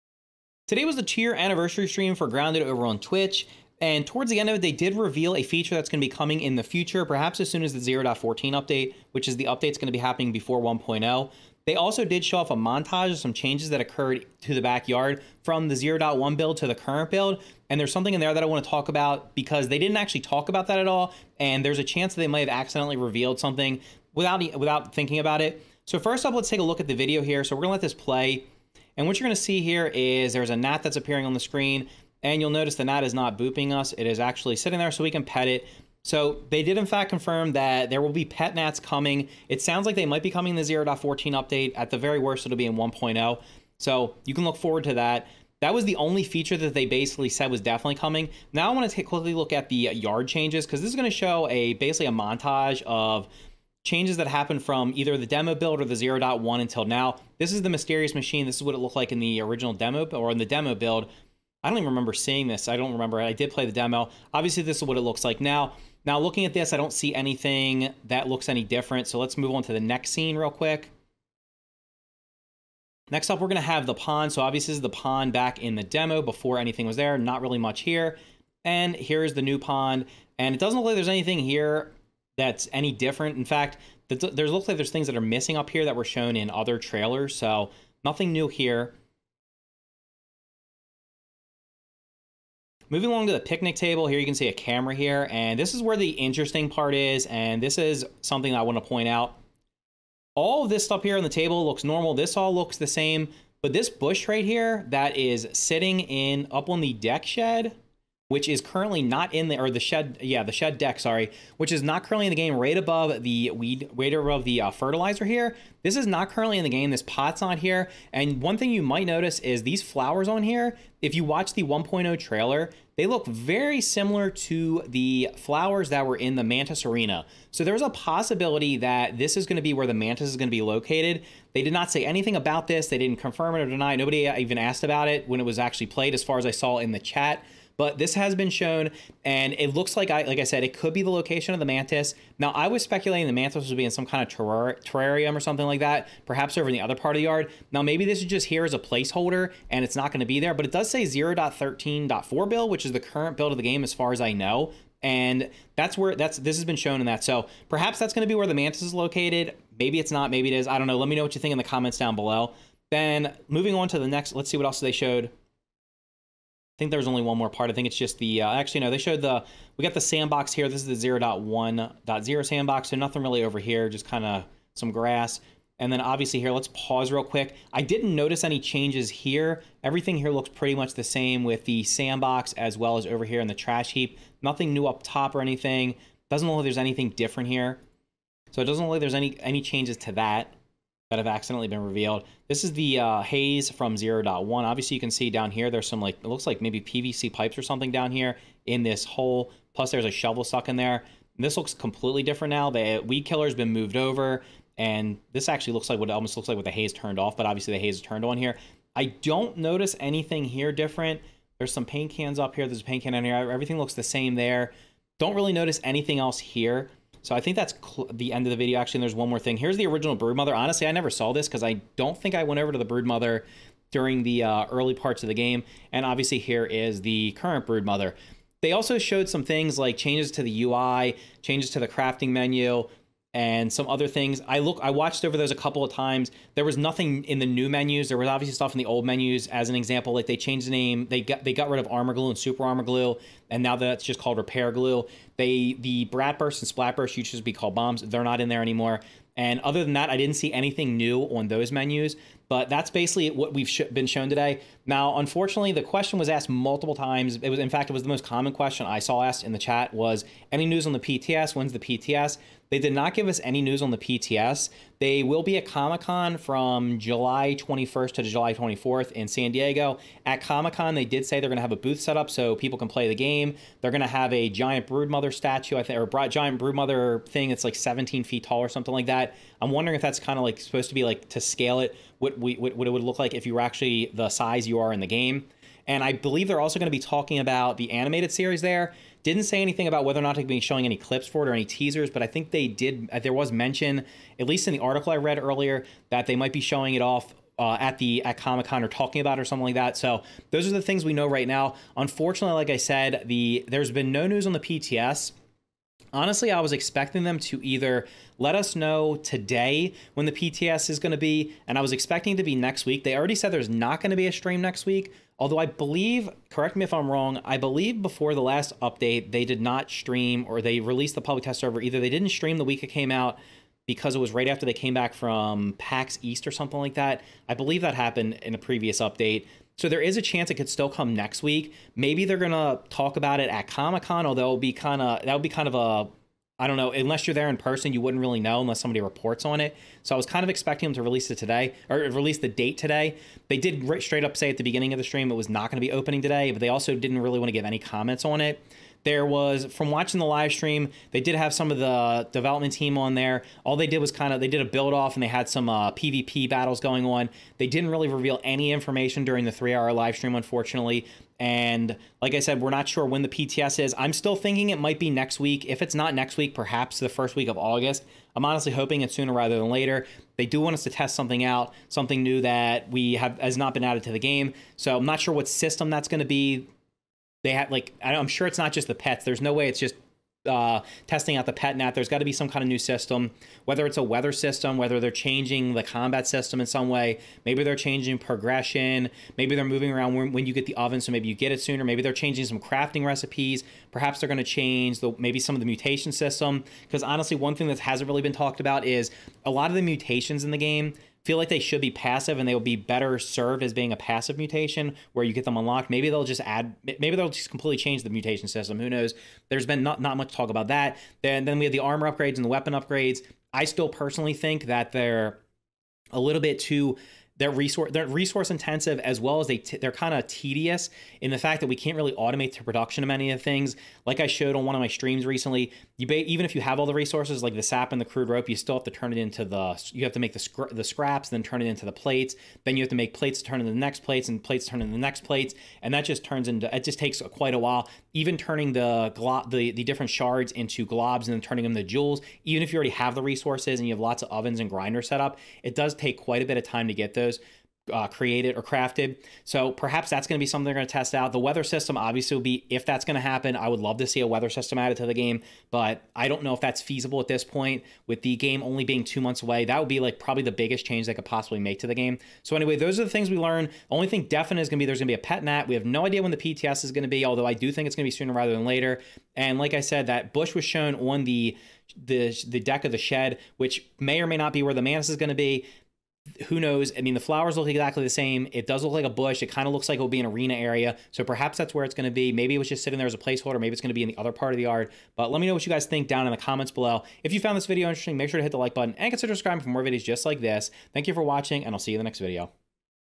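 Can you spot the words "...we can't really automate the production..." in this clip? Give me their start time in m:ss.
7:01.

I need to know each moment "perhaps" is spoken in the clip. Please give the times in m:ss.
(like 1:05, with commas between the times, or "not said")
0:07, 2:26, 2:37, 6:06, 6:33, 7:29, 8:01.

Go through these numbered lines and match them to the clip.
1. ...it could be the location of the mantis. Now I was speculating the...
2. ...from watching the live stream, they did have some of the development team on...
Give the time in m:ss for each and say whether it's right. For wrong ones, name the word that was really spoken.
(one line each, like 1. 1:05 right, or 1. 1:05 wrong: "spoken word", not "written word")
1. 2:20 right
2. 5:49 right.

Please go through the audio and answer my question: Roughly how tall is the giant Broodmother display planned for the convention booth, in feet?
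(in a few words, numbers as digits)
17.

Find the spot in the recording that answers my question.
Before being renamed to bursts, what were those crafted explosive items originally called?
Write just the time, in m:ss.
4:07.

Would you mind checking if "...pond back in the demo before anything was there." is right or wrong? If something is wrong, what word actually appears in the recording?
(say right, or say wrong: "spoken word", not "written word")
right.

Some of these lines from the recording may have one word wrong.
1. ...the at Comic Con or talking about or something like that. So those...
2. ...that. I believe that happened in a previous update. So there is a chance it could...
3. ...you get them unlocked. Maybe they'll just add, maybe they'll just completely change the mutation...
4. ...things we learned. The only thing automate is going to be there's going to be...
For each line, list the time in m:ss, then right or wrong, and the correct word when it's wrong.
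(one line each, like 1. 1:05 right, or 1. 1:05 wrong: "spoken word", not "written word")
1. 4:57 right
2. 5:26 right
3. 6:45 right
4. 7:43 wrong: "definite", not "automate".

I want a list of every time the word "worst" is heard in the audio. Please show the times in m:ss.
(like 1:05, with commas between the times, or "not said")
0:42.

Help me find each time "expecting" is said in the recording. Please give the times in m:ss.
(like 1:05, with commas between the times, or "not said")
5:06, 5:11, 5:40.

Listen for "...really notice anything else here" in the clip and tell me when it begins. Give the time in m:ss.
3:35.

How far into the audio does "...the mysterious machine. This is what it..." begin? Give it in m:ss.
0:57.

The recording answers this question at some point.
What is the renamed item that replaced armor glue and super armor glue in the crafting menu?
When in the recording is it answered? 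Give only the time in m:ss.
4:04.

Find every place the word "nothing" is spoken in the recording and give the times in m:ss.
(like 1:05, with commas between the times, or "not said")
1:28, 2:52, 3:04, 3:56.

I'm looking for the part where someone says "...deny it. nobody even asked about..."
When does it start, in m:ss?
2:13.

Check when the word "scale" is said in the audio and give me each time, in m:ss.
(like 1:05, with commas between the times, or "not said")
4:41.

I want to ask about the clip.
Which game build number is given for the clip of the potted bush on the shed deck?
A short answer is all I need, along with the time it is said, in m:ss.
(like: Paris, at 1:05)
0.13.4, at 2:31.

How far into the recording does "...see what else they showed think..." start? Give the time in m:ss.
2:44.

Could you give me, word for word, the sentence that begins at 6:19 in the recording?
There's no way it's just uh, testing out the pet net.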